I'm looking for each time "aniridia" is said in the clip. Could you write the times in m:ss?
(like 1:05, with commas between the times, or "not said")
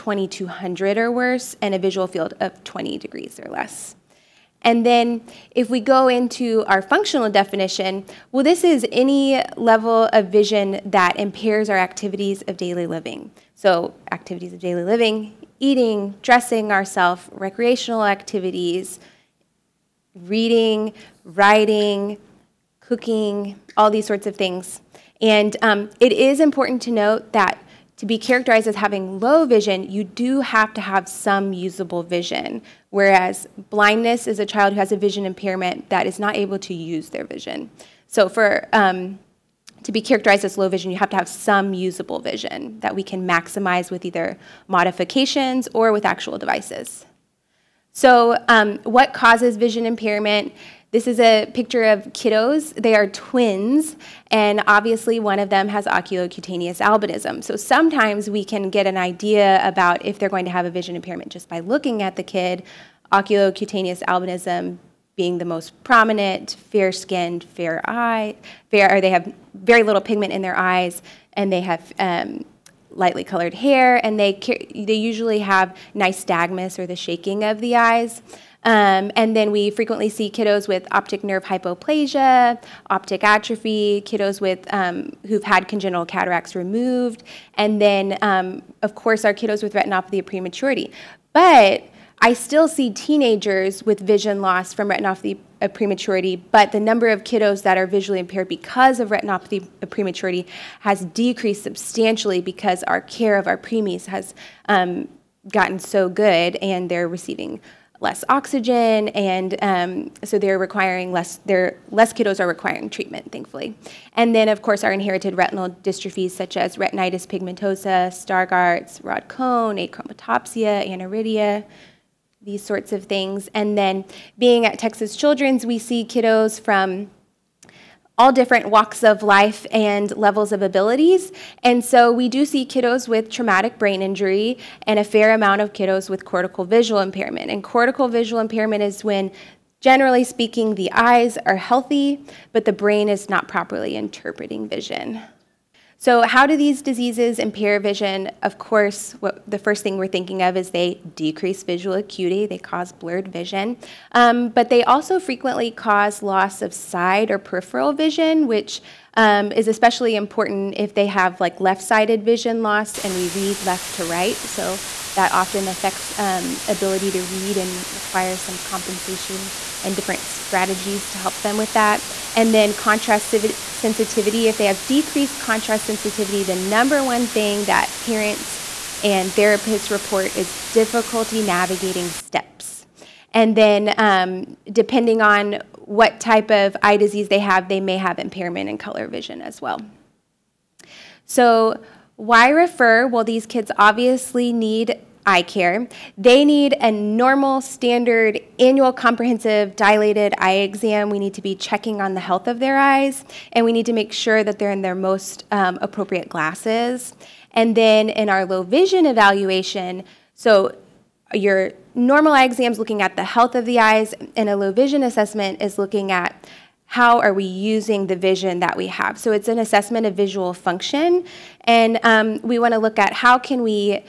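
2:00.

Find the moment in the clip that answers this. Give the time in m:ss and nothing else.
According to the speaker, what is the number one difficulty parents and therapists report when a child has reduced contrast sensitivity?
3:01.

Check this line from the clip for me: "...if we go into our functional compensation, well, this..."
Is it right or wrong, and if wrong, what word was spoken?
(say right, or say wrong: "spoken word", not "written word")
wrong: "definition", not "compensation".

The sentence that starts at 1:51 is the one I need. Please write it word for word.
They're, less kiddos are requiring treatment, thankfully.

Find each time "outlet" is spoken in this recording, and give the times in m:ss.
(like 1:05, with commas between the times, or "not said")
not said.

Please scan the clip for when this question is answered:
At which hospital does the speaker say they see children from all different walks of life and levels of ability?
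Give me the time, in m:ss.
2:04.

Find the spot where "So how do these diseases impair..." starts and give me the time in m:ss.
2:25.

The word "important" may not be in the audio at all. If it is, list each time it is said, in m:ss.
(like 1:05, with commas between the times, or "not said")
0:26, 2:40.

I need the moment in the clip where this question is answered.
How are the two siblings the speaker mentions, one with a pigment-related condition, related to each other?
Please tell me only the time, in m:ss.
0:53.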